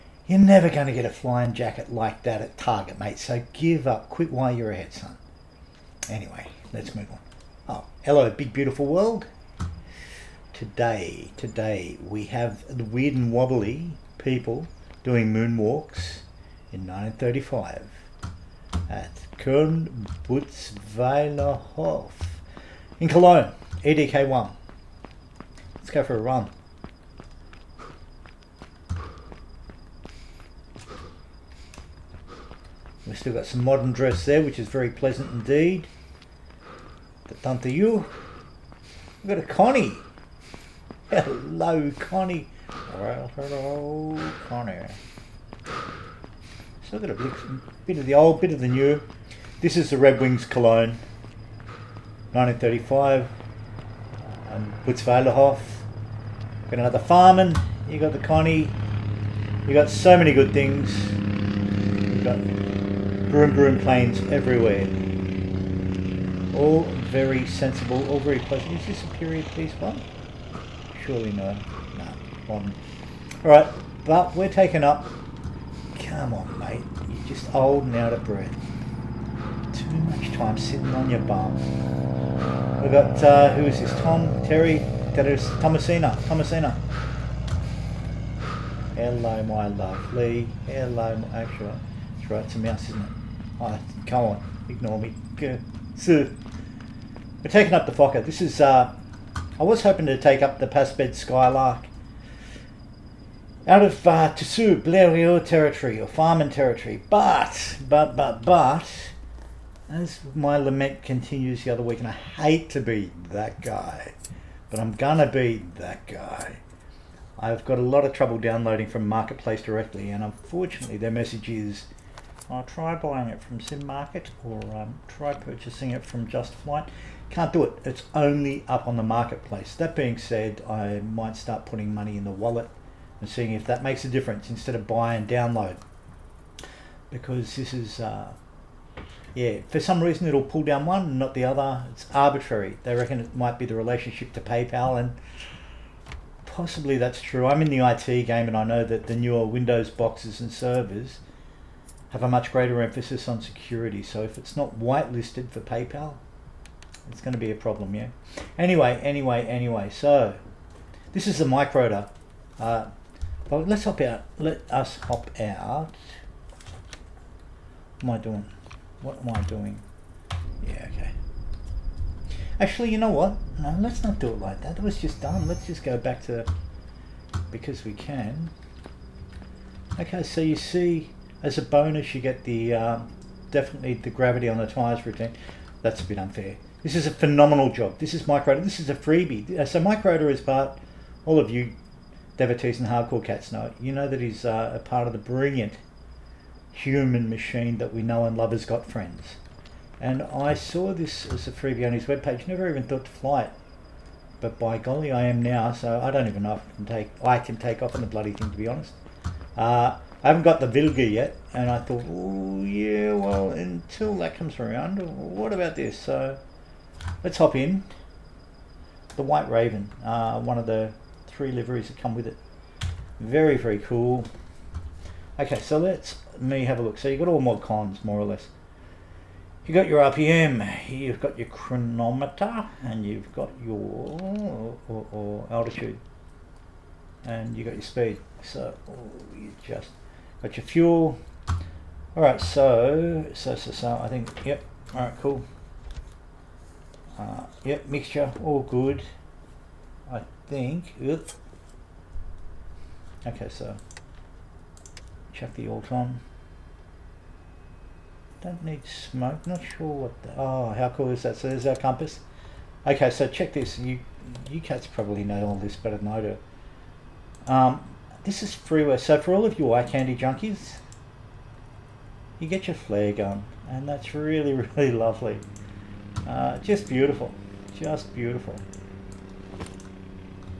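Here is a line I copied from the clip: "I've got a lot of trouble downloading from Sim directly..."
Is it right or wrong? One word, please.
wrong.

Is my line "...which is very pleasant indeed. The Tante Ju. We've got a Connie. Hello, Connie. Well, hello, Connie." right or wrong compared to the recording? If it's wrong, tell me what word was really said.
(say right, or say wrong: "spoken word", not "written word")
right.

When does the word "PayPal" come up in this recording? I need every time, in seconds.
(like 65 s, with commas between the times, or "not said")
144 s, 155 s.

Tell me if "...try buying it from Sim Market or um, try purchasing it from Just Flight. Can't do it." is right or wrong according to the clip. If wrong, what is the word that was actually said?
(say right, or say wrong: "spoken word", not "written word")
right.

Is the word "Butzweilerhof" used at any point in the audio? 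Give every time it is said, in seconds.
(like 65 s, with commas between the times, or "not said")
20 s, 54 s.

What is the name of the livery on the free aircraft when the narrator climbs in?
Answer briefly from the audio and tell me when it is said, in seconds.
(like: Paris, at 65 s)
The White Raven, at 219 s.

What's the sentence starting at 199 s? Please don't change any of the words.
And I saw this as a freebie on his webpage, never even thought to fly it.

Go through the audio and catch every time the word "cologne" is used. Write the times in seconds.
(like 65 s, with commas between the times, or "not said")
23 s, 50 s.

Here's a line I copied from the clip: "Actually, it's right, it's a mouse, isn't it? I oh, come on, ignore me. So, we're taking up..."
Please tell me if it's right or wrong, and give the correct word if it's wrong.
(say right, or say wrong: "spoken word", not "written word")
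right.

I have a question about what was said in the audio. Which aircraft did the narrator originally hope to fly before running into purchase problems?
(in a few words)
Skylark.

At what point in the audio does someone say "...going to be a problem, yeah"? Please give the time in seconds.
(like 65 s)
157 s.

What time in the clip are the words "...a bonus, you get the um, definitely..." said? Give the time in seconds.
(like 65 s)
181 s.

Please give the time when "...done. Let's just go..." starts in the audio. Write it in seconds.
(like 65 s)
175 s.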